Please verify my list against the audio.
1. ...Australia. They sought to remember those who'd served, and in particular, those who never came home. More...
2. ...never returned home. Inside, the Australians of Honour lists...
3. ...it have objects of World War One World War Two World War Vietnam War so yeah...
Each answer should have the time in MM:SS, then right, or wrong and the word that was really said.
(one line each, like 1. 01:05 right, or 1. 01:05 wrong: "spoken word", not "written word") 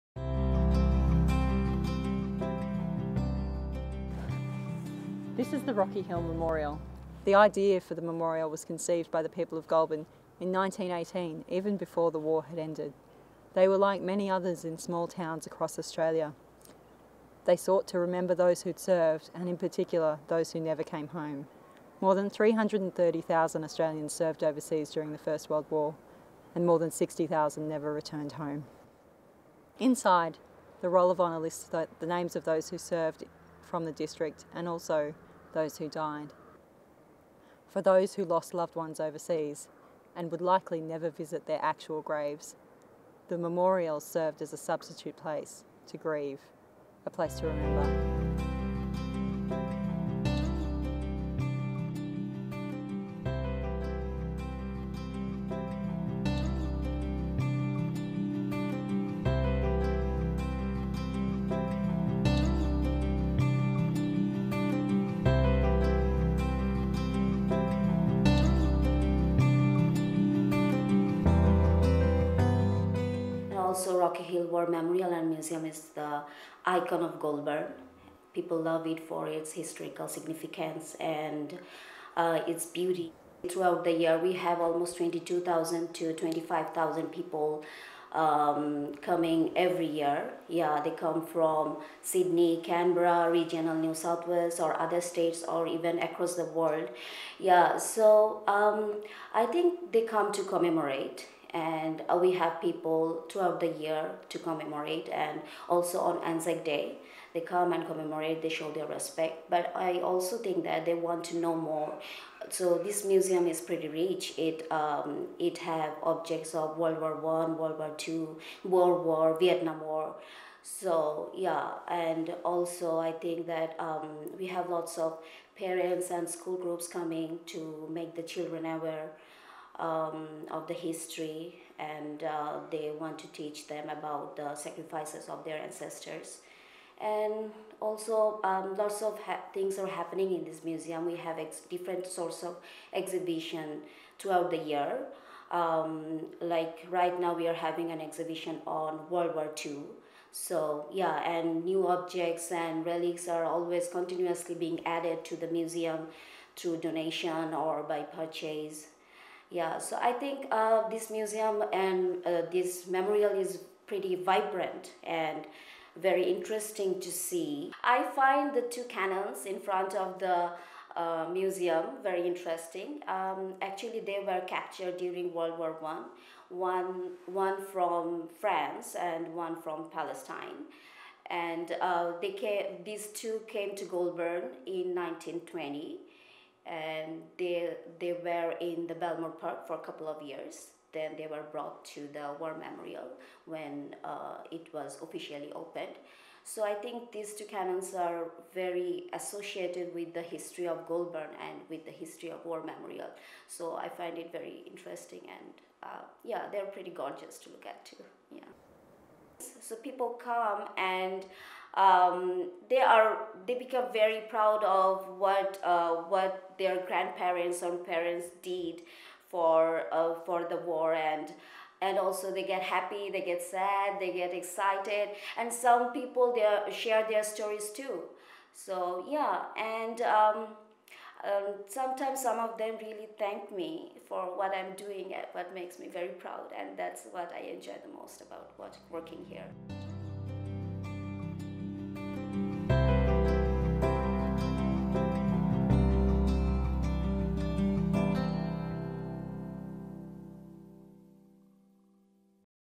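1. 00:15 right
2. 00:27 wrong: "Roll", not "Australians"
3. 01:55 right.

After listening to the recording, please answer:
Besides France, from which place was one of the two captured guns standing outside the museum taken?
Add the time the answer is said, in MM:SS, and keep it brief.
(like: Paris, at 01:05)
Palestine, at 02:59.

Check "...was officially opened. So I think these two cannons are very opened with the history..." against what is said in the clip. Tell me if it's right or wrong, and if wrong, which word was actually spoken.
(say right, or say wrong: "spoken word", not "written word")
wrong: "associated", not "opened".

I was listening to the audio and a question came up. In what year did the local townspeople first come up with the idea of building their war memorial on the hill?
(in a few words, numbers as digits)
1918.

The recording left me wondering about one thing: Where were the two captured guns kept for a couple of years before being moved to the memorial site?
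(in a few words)
Belmore Park.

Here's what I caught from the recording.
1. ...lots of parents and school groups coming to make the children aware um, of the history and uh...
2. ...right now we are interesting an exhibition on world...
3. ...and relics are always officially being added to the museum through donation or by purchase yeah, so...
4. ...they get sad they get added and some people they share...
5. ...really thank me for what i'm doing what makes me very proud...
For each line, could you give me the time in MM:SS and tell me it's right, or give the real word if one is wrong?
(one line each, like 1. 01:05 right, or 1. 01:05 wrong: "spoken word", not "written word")
1. 02:04 right
2. 02:26 wrong: "having", not "interesting"
3. 02:32 wrong: "continuously", not "officially"
4. 03:43 wrong: "excited", not "added"
5. 03:52 right.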